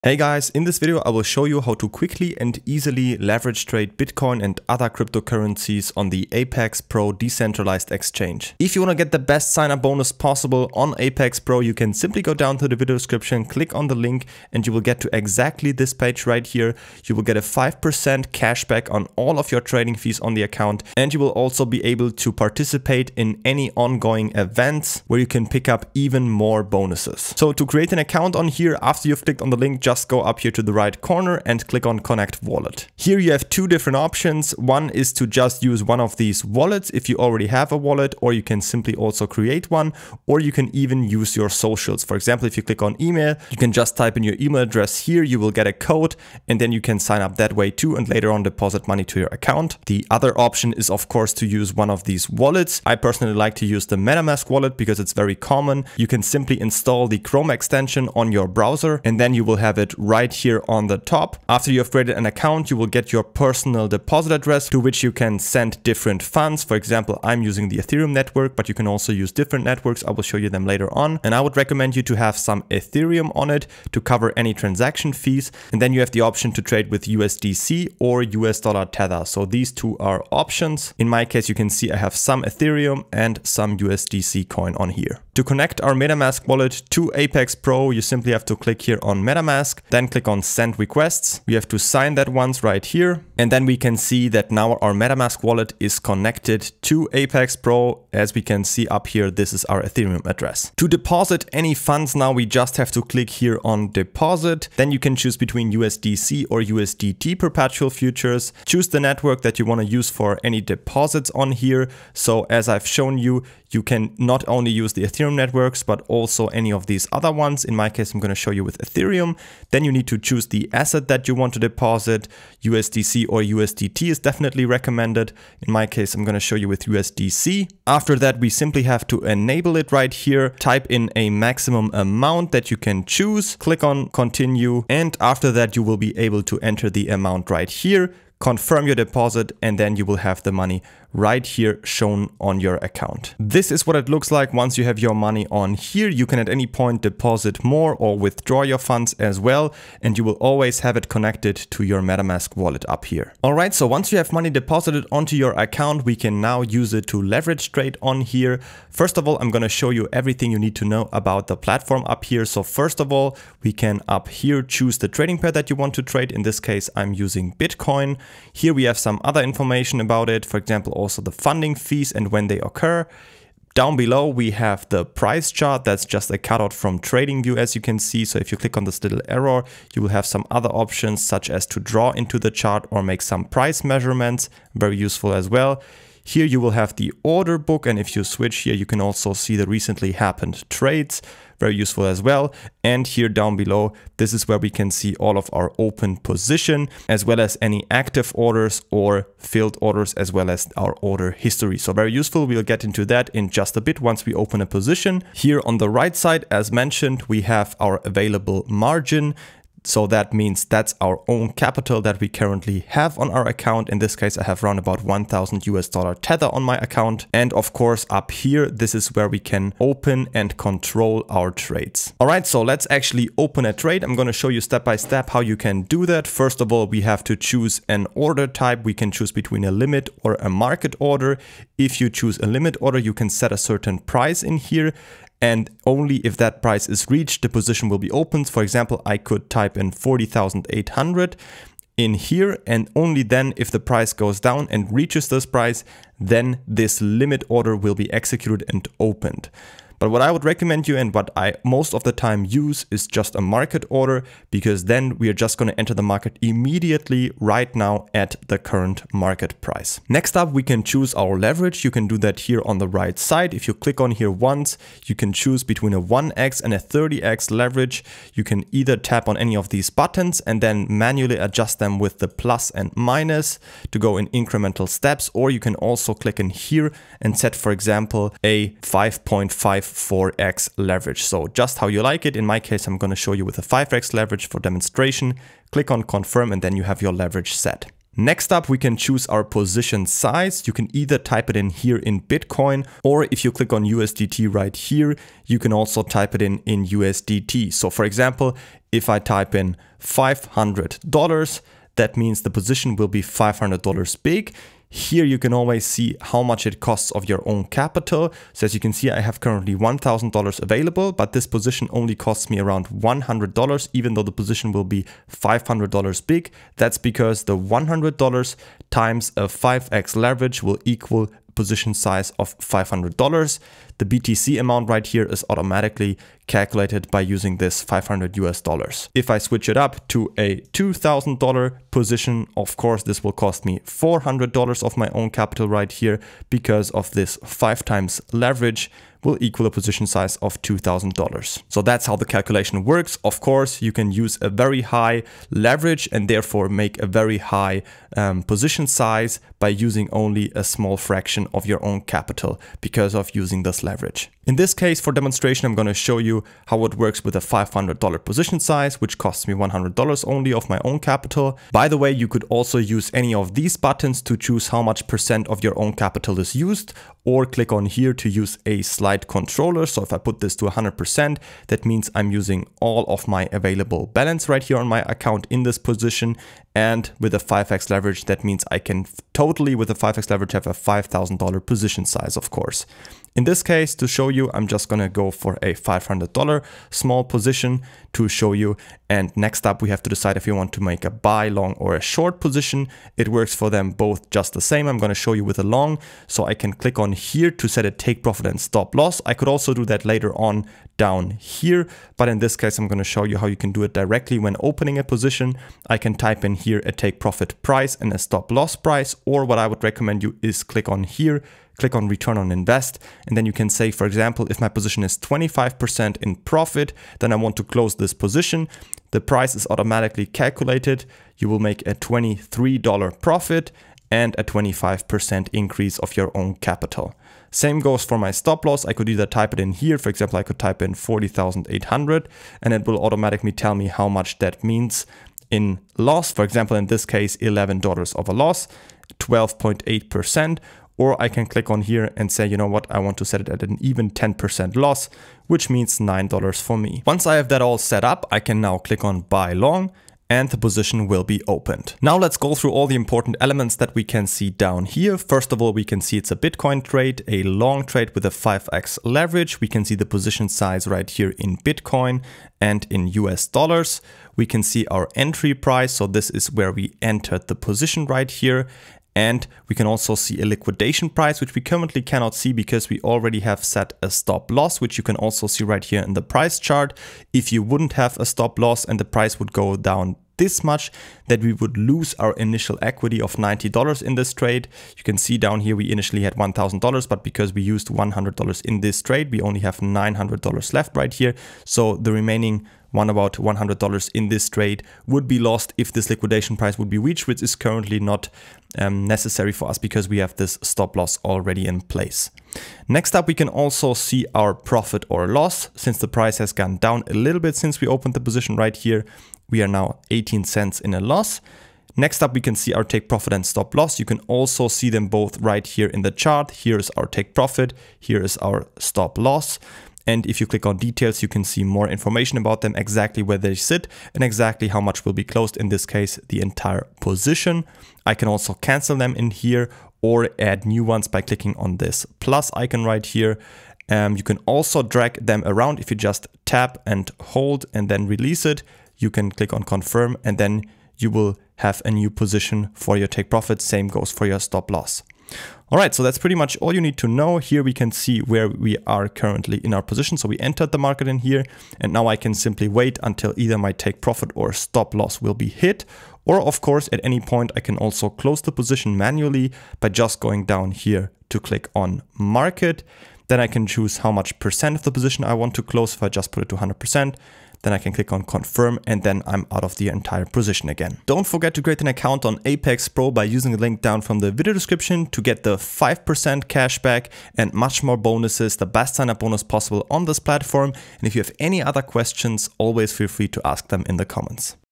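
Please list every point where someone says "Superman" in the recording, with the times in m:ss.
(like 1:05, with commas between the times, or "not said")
not said.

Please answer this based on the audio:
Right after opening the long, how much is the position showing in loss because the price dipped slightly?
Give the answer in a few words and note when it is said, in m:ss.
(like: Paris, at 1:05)
18 cents, at 8:30.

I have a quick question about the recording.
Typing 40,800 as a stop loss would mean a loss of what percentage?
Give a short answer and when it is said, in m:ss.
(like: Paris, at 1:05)
12.8%, at 7:19.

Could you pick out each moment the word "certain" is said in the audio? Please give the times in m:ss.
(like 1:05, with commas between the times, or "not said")
3:53.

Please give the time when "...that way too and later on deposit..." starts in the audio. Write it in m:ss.
0:47.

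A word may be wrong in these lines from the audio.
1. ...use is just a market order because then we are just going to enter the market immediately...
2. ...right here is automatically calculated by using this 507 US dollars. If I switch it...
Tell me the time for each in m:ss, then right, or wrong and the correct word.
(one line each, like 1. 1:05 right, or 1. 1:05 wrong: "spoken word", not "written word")
1. 4:12 right
2. 5:24 wrong: "500", not "507".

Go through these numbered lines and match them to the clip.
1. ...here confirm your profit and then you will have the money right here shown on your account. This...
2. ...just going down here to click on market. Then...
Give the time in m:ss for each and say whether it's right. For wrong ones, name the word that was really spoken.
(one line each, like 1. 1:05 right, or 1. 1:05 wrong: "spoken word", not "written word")
1. 2:17 wrong: "deposit", not "profit"
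2. 9:19 right.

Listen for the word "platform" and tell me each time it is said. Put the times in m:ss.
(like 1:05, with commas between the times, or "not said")
2:41, 9:40.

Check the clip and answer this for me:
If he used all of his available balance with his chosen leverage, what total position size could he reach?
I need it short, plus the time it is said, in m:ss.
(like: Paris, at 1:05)
$5,000, at 6:20.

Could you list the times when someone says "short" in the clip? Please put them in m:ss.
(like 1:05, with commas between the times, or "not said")
6:32.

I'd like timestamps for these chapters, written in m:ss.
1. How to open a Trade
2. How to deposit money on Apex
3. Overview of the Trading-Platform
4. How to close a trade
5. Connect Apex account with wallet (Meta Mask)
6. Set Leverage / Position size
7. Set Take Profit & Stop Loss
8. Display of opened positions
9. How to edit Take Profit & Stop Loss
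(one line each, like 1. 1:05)
1. 3:43
2. 1:40
3. 2:38
4. 9:10
5. 0:30
6. 4:20
7. 6:00
8. 7:30
9. 8:30.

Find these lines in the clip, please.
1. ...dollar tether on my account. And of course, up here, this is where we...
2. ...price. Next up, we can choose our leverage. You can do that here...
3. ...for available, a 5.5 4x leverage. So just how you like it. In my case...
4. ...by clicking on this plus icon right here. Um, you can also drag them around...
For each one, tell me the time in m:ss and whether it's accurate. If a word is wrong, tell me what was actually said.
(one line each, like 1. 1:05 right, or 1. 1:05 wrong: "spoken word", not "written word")
1. 3:35 right
2. 4:19 right
3. 4:37 wrong: "example", not "available"
4. 8:51 right.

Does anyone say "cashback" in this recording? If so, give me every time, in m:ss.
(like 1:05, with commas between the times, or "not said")
0:18, 9:36.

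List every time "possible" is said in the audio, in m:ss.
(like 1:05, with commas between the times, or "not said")
0:10, 9:39.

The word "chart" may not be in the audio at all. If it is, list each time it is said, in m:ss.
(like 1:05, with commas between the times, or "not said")
2:55, 3:02, 7:56, 8:36.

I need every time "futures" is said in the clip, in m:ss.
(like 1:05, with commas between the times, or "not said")
1:47.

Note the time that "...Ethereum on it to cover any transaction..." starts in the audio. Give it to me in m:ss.
1:12.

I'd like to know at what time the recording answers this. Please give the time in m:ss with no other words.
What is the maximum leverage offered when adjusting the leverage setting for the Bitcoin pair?
4:26.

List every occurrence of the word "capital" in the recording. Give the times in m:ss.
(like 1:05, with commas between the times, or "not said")
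3:31, 5:07, 5:35, 5:52, 6:00, 6:05, 7:06.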